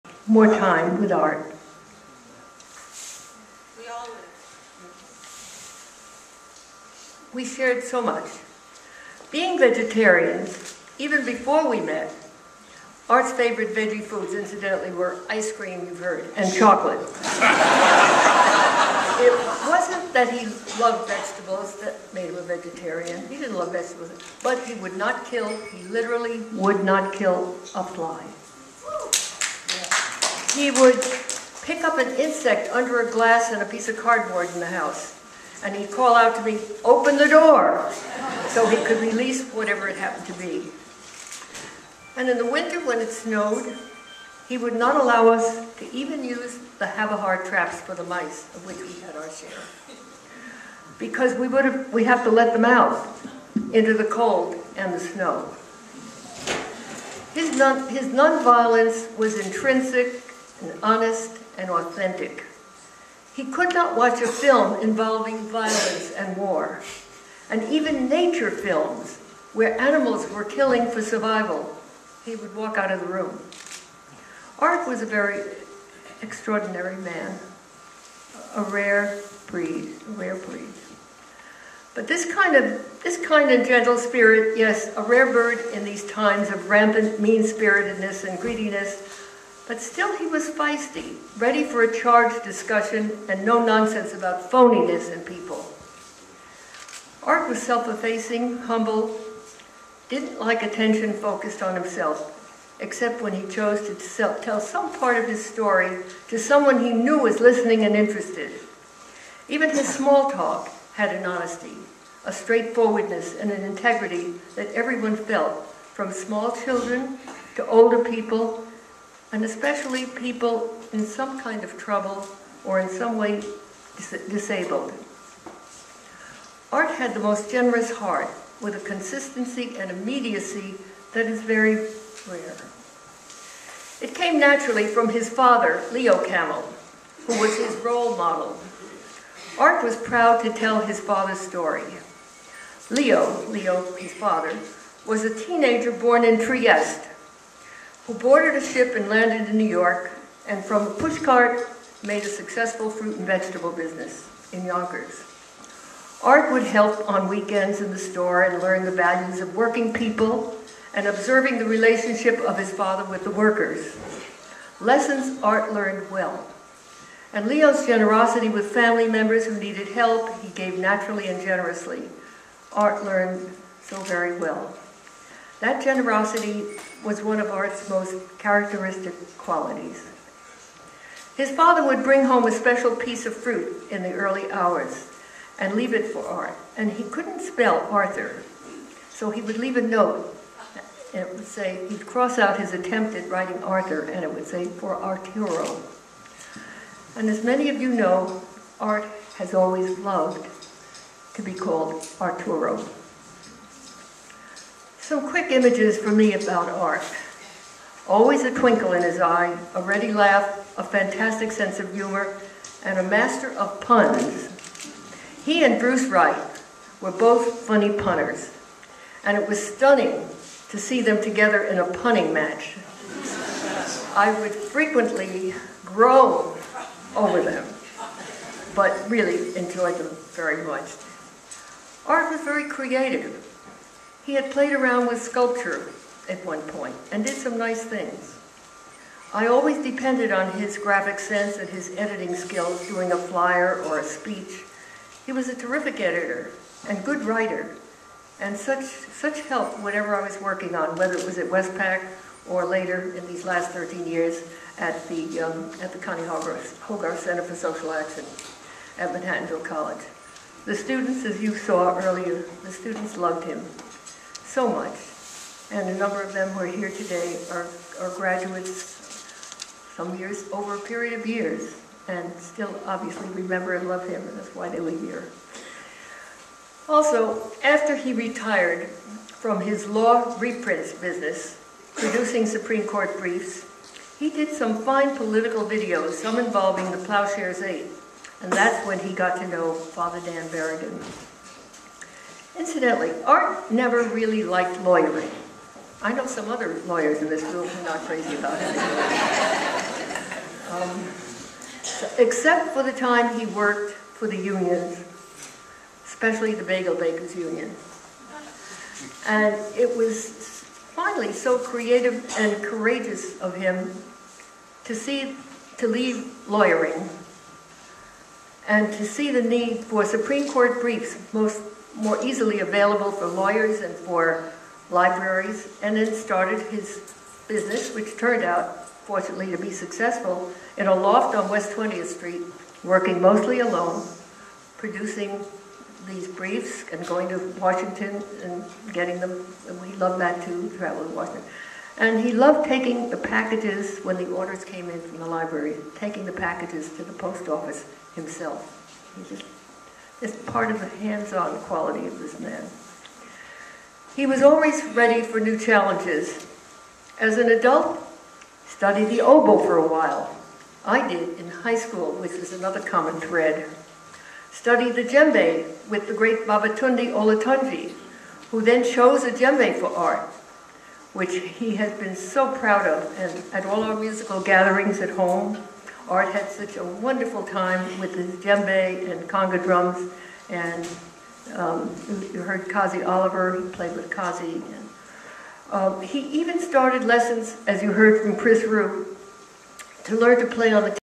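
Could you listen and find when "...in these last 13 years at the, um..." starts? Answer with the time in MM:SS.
04:13.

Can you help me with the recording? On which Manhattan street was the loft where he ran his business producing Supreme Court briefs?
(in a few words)
West 20th Street.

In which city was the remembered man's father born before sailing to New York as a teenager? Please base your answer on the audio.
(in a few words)
Trieste.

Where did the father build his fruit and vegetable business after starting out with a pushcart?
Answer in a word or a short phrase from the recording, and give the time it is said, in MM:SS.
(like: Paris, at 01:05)
Yonkers, at 02:34.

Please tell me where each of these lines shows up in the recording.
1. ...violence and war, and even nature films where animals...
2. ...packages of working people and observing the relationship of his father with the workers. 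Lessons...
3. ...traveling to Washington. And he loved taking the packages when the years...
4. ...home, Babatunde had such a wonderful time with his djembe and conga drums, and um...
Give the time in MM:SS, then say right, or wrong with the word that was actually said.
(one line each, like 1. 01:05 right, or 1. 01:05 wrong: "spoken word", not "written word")
1. 01:05 right
2. 02:38 wrong: "values", not "packages"
3. 05:40 wrong: "orders", not "years"
4. 06:15 wrong: "Art", not "Babatunde".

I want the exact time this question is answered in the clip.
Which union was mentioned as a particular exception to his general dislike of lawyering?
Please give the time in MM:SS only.
05:06.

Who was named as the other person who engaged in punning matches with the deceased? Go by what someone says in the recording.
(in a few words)
Bruce Wright.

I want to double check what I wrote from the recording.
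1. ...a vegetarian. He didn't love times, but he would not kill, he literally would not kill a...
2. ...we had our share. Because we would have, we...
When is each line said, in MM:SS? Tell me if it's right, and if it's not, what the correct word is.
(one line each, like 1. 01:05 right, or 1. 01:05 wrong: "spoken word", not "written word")
1. 00:22 wrong: "vegetables", not "times"
2. 00:48 right.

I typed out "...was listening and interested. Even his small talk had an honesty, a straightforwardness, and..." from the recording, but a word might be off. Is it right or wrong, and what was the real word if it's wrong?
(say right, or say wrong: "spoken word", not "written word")
right.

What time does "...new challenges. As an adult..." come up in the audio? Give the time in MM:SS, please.
05:55.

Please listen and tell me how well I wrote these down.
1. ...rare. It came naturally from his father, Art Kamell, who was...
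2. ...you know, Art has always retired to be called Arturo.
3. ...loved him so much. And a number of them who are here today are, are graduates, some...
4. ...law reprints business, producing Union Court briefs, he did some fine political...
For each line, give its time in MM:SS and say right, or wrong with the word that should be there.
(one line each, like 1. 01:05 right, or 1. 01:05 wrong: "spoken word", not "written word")
1. 02:12 wrong: "Leo", not "Art"
2. 03:17 wrong: "loved", not "retired"
3. 04:23 right
4. 04:39 wrong: "Supreme", not "Union".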